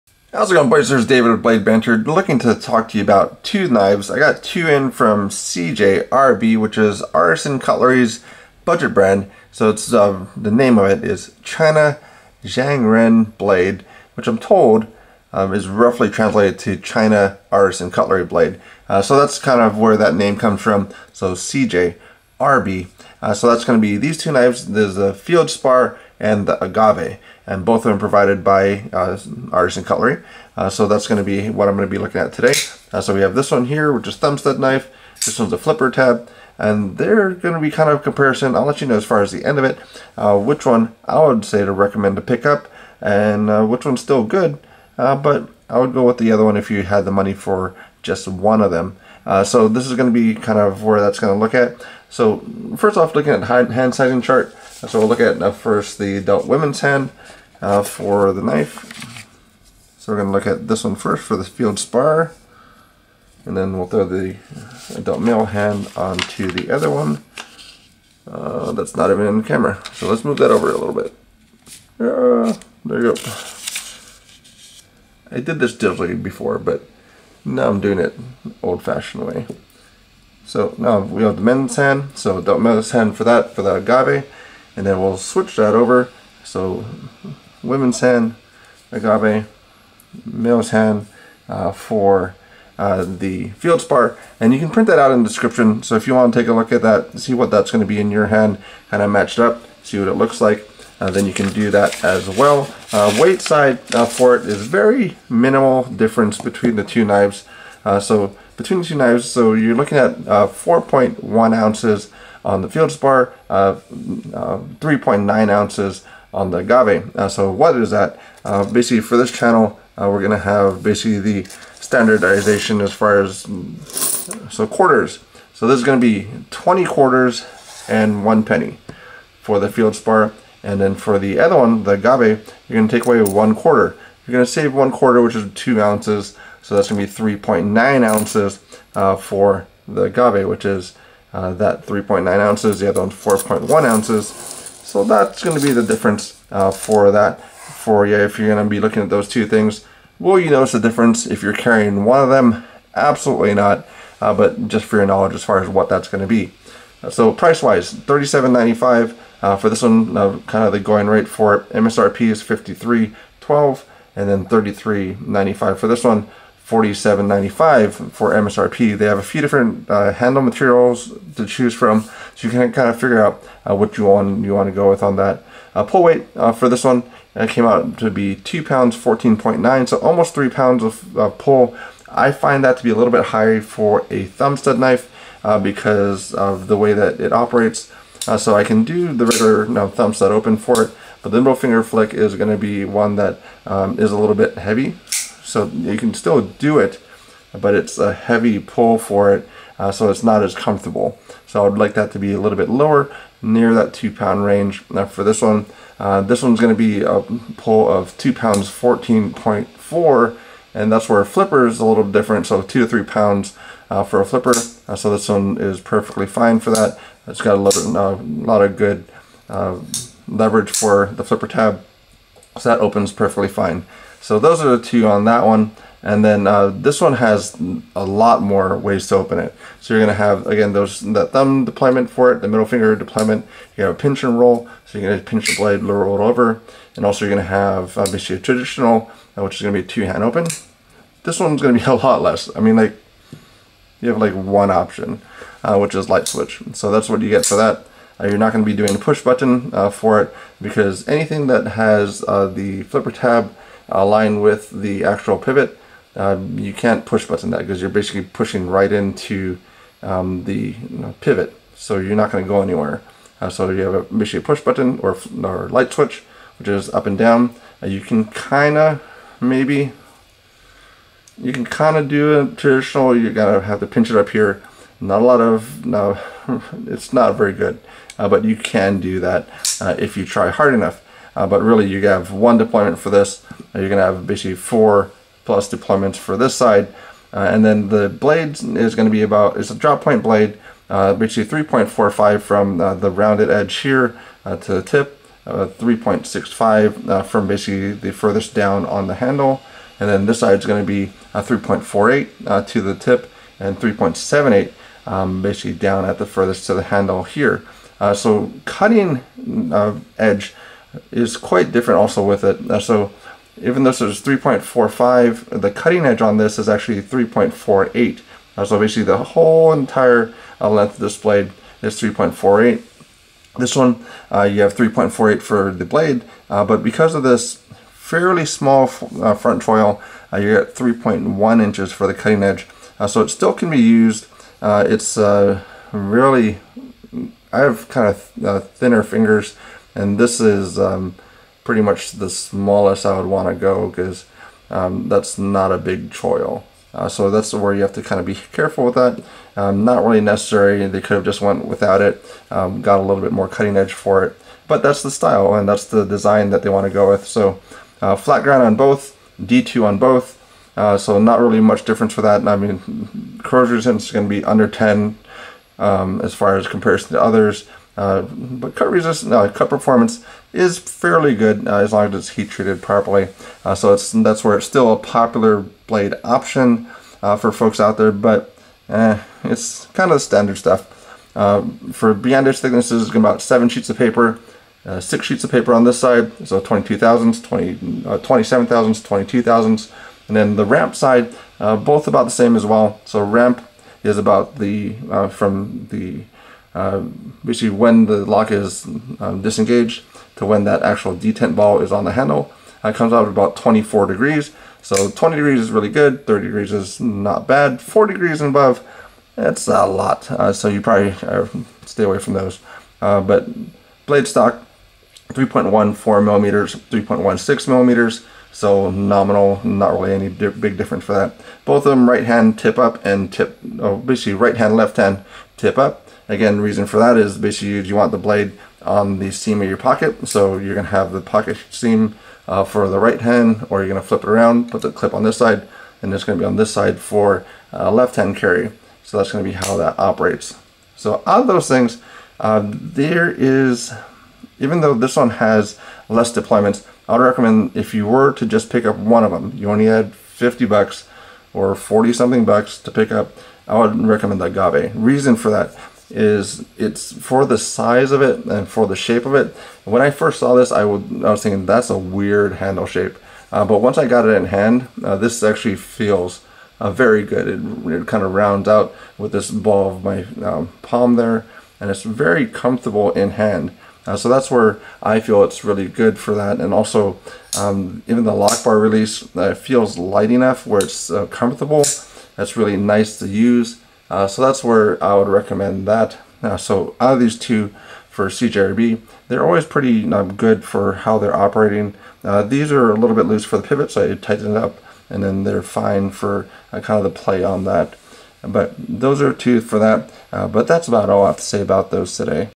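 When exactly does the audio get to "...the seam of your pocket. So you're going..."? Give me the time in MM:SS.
07:09.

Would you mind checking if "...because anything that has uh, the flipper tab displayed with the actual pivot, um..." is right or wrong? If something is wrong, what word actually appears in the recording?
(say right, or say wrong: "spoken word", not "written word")
wrong: "aligned", not "displayed".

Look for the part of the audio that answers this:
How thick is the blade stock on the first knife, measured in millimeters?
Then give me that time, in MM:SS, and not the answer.
06:55.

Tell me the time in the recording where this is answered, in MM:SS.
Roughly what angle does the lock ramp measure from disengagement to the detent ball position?
06:43.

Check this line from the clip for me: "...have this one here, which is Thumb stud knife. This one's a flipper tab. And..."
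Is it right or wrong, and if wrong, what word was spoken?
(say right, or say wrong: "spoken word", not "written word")
right.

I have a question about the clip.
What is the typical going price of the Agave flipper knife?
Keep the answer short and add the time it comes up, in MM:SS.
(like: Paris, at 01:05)
$33.95, at 02:44.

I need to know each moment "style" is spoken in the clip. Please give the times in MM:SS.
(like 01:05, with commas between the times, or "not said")
05:55.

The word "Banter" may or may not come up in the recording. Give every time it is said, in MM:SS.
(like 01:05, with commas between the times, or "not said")
00:01.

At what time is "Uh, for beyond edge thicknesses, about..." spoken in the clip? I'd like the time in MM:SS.
06:21.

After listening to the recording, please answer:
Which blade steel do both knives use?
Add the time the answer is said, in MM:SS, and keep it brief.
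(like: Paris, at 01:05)
D2, at 05:59.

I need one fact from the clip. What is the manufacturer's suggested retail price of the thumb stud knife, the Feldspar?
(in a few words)
$53.12.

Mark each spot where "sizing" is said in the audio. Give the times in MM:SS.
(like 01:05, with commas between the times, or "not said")
00:53.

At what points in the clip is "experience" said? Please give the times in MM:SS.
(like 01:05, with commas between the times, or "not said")
not said.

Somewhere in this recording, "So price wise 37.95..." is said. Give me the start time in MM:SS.
02:37.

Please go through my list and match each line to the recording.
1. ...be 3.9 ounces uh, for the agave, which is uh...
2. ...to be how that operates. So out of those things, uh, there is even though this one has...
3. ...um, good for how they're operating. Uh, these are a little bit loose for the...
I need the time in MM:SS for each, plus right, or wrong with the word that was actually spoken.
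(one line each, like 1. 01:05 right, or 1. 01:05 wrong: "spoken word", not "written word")
1. 02:17 right
2. 07:19 right
3. 08:10 right.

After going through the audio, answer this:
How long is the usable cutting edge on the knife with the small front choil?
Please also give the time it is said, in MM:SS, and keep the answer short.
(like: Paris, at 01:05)
3.1 inches, at 05:30.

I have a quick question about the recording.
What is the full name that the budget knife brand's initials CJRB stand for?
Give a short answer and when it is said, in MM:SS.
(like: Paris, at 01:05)
China Jiangren Blade, at 00:11.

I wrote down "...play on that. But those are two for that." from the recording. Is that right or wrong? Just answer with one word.
right.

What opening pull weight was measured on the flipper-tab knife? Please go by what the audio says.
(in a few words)
2 pounds 14.4.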